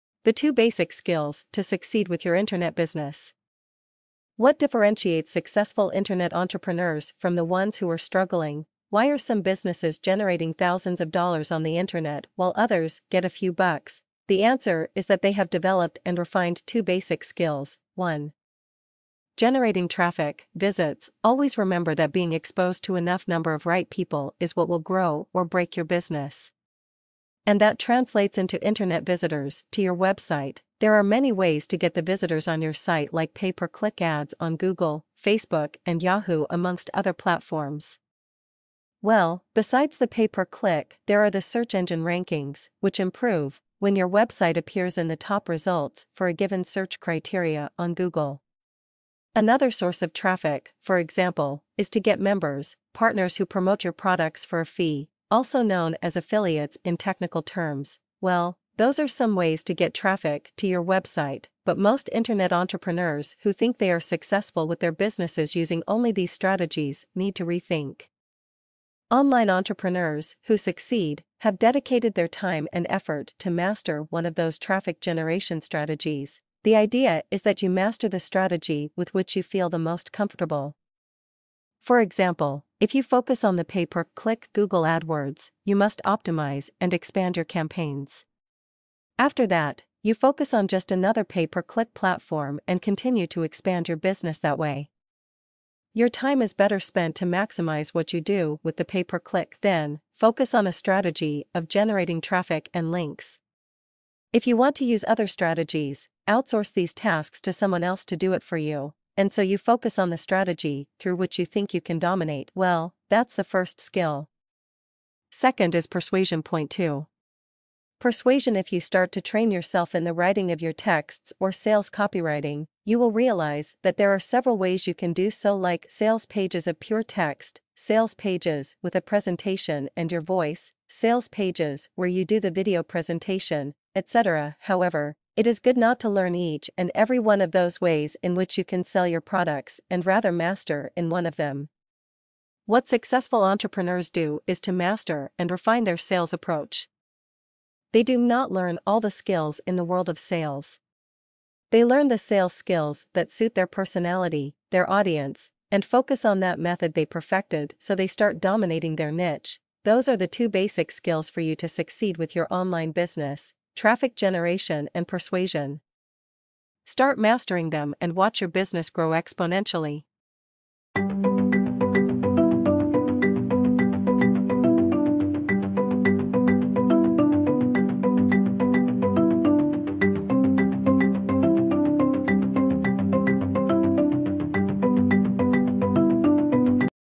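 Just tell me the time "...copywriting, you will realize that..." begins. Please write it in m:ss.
2:01.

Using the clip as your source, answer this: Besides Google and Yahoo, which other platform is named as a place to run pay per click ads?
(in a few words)
Facebook.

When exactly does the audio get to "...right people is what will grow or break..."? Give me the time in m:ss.
0:23.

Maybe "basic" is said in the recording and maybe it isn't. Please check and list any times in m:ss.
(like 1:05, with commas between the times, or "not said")
0:00, 0:16, 2:40.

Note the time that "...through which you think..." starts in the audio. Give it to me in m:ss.
1:50.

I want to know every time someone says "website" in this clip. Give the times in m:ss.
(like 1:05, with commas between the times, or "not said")
0:29, 0:44, 1:00.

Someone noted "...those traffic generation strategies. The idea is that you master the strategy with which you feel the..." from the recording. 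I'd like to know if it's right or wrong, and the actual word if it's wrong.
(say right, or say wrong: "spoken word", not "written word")
right.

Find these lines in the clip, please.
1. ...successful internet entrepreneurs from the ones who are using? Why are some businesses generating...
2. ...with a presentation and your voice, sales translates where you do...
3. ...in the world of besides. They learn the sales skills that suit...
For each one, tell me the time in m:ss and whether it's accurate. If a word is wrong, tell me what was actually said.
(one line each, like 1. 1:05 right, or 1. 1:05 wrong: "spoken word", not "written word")
1. 0:05 wrong: "struggling", not "using"
2. 2:08 wrong: "pages", not "translates"
3. 2:29 wrong: "sales", not "besides".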